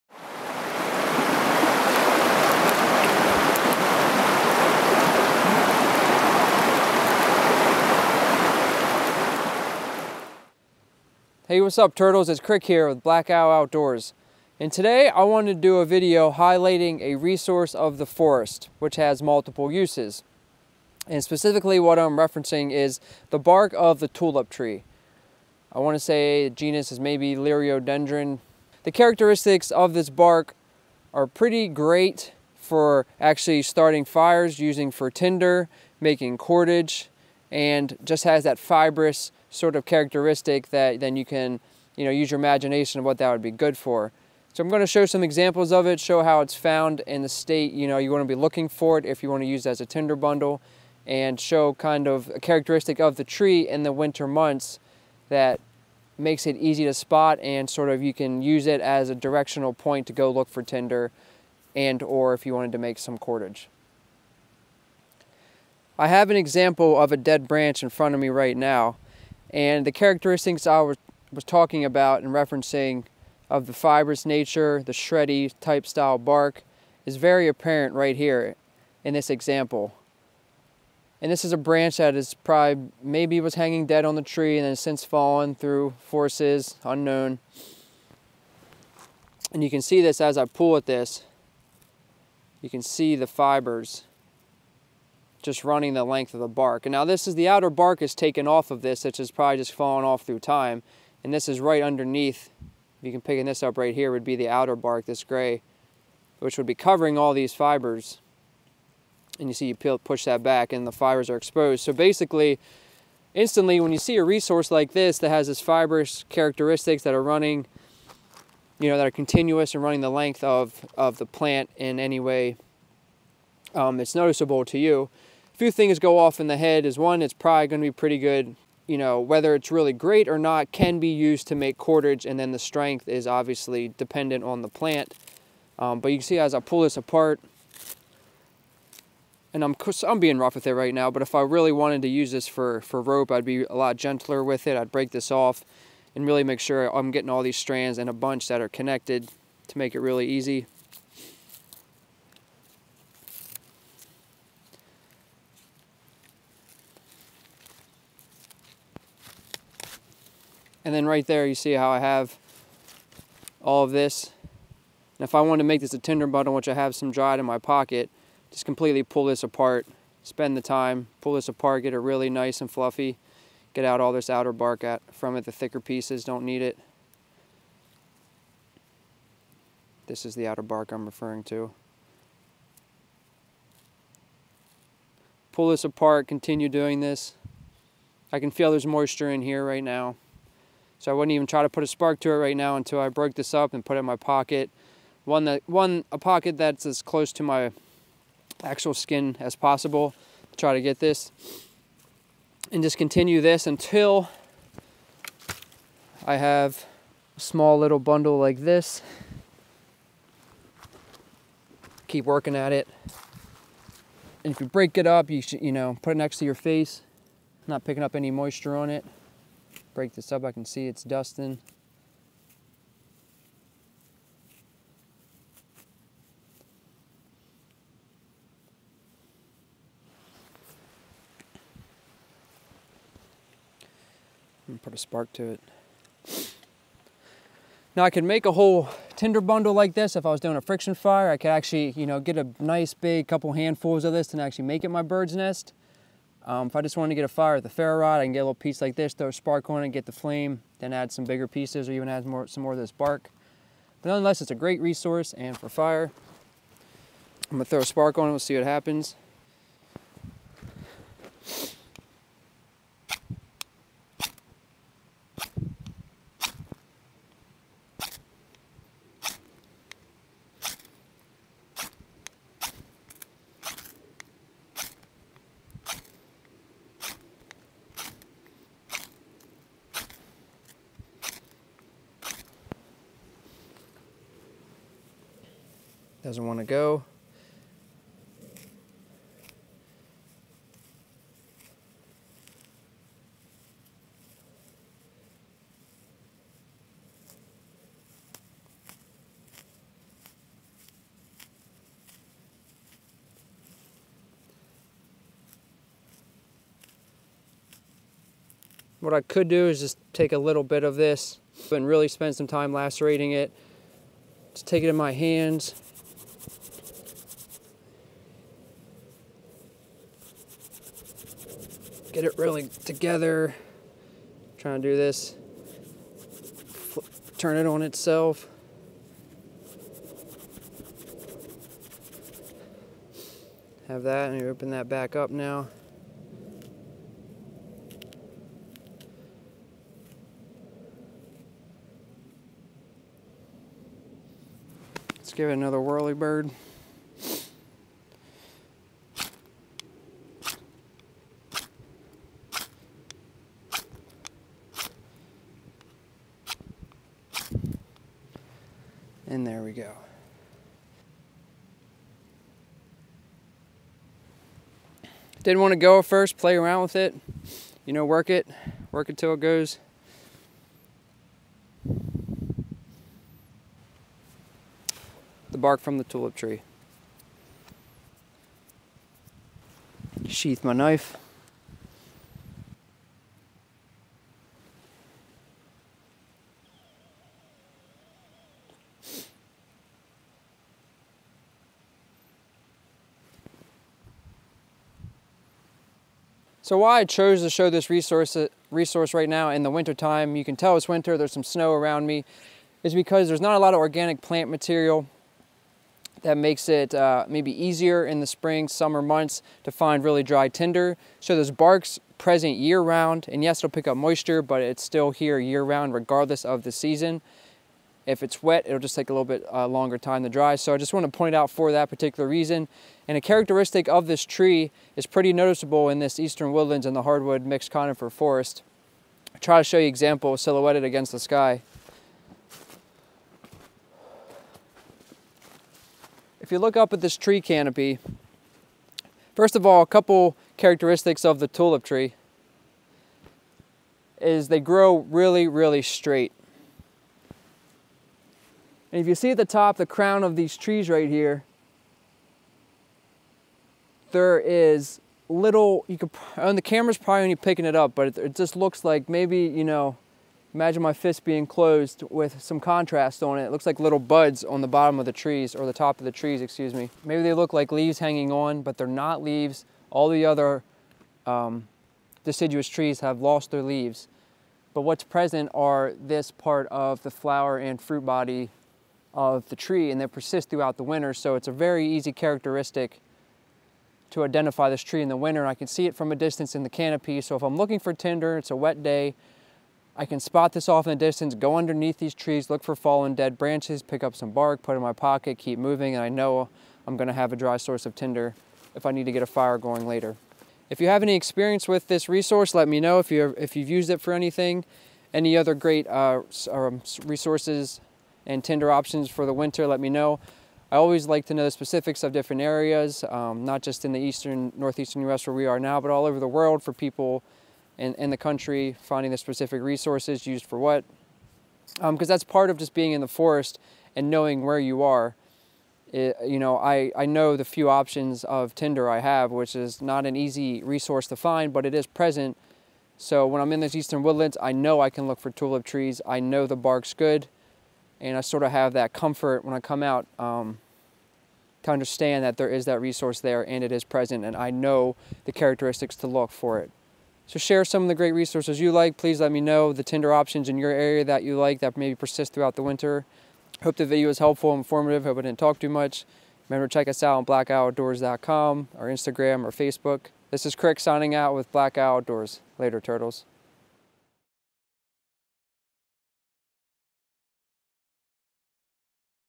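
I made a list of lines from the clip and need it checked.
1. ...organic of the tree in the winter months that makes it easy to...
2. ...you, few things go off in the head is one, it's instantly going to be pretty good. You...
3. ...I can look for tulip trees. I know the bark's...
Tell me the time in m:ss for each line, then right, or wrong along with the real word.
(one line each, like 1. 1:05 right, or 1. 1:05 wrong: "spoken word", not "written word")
1. 0:52 wrong: "characteristic", not "organic"
2. 2:04 wrong: "probably", not "instantly"
3. 8:54 right.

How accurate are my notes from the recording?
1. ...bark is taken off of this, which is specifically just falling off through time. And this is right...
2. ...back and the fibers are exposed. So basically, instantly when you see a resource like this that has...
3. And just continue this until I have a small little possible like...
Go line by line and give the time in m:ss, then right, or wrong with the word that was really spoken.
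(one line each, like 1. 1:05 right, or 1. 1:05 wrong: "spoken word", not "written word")
1. 1:37 wrong: "probably", not "specifically"
2. 1:50 right
3. 3:22 wrong: "bundle", not "possible".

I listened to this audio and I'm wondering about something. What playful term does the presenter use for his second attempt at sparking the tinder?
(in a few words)
whirly bird.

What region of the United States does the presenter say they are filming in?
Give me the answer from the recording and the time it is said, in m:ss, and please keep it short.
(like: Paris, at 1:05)
northeastern U.S., at 8:34.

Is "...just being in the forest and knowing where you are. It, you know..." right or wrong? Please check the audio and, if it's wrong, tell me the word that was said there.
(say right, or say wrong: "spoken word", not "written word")
right.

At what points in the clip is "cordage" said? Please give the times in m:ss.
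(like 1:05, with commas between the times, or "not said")
0:36, 1:03, 2:11.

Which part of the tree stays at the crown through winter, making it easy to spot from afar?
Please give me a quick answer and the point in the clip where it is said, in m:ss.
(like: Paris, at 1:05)
flower and fruit body, at 7:57.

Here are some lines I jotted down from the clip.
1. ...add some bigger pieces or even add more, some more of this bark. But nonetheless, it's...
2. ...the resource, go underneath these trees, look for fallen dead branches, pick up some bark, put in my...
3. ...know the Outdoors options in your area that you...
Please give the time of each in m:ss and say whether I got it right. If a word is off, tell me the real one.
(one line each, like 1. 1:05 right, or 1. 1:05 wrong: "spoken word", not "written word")
1. 4:10 right
2. 8:10 wrong: "distance", not "resource"
3. 9:09 wrong: "Tinder", not "Outdoors".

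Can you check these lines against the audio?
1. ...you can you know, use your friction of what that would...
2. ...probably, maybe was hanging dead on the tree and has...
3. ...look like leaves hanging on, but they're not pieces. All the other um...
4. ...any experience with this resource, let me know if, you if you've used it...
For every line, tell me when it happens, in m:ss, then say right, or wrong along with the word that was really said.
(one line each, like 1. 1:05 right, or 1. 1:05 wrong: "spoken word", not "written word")
1. 0:41 wrong: "imagination", not "friction"
2. 1:22 right
3. 7:47 wrong: "leaves", not "pieces"
4. 8:21 right.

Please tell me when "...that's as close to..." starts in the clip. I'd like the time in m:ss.
3:16.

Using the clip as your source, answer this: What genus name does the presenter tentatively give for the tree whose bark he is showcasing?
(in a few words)
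Liriodendron.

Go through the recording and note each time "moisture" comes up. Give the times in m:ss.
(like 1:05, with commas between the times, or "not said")
3:08, 3:38, 6:53.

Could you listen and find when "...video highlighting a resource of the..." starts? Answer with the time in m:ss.
0:15.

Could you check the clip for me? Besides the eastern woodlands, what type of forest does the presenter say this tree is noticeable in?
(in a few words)
hardwood mixed conifer forest.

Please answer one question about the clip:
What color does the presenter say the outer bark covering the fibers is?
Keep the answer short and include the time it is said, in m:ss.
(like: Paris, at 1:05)
gray, at 1:45.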